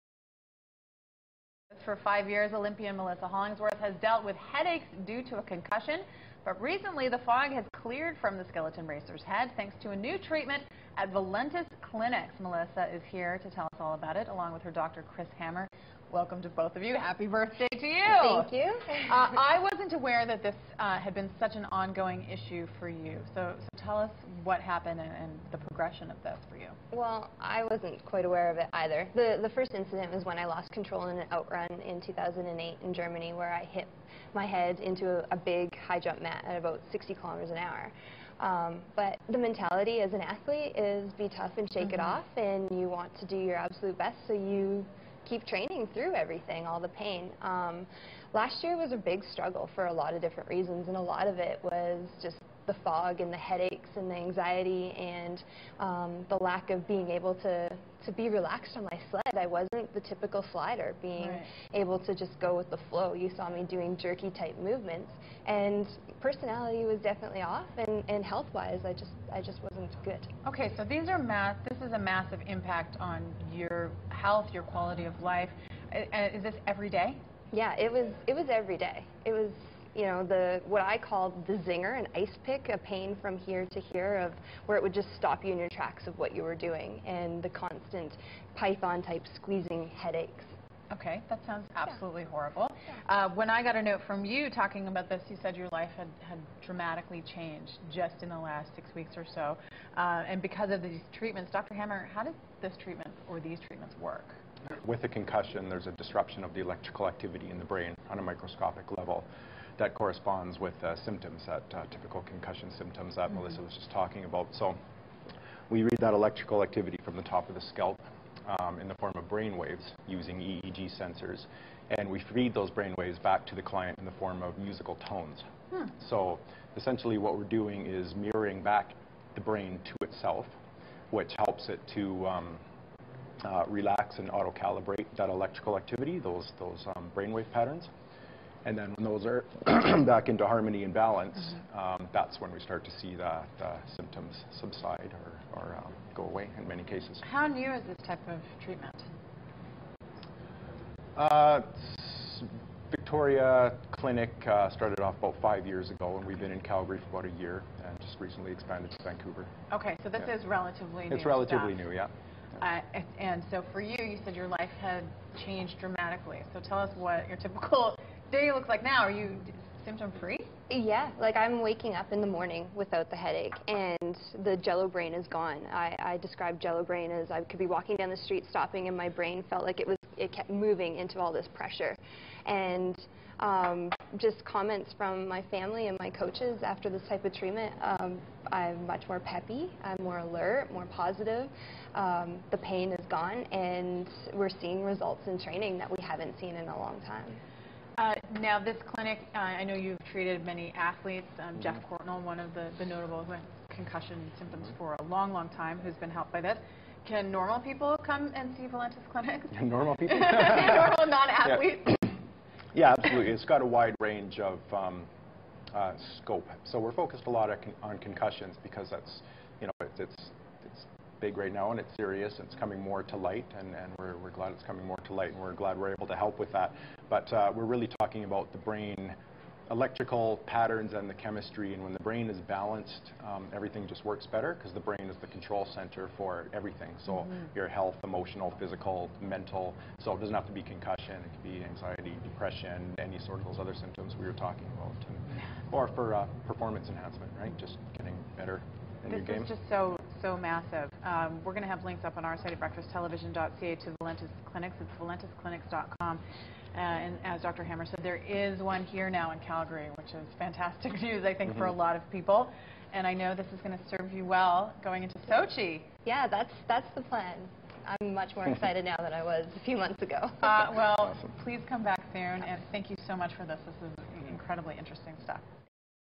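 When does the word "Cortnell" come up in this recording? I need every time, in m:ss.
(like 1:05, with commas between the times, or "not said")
3:22.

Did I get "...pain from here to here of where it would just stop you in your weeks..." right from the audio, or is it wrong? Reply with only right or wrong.
wrong.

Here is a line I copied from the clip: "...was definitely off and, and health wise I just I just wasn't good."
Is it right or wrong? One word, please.
right.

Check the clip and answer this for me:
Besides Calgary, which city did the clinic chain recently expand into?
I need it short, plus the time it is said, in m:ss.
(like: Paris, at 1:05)
Vancouver, at 2:39.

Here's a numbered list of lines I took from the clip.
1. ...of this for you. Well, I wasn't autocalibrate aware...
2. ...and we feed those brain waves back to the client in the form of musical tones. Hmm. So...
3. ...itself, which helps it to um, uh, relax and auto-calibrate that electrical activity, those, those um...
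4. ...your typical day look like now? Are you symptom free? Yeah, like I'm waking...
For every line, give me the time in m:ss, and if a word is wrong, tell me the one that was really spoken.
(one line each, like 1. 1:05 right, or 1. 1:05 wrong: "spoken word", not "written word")
1. 0:26 wrong: "quite", not "autocalibrate"
2. 2:01 right
3. 2:10 right
4. 2:47 right.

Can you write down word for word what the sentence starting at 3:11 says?
Um, the pain is gone and we're seeing results in training that we haven't seen in a long time.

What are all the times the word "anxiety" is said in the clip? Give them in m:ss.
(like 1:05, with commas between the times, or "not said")
0:54, 4:01.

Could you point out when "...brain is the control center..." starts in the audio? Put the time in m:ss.
3:54.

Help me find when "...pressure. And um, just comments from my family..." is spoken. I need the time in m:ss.
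3:01.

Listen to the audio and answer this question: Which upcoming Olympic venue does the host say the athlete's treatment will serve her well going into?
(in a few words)
Sochi.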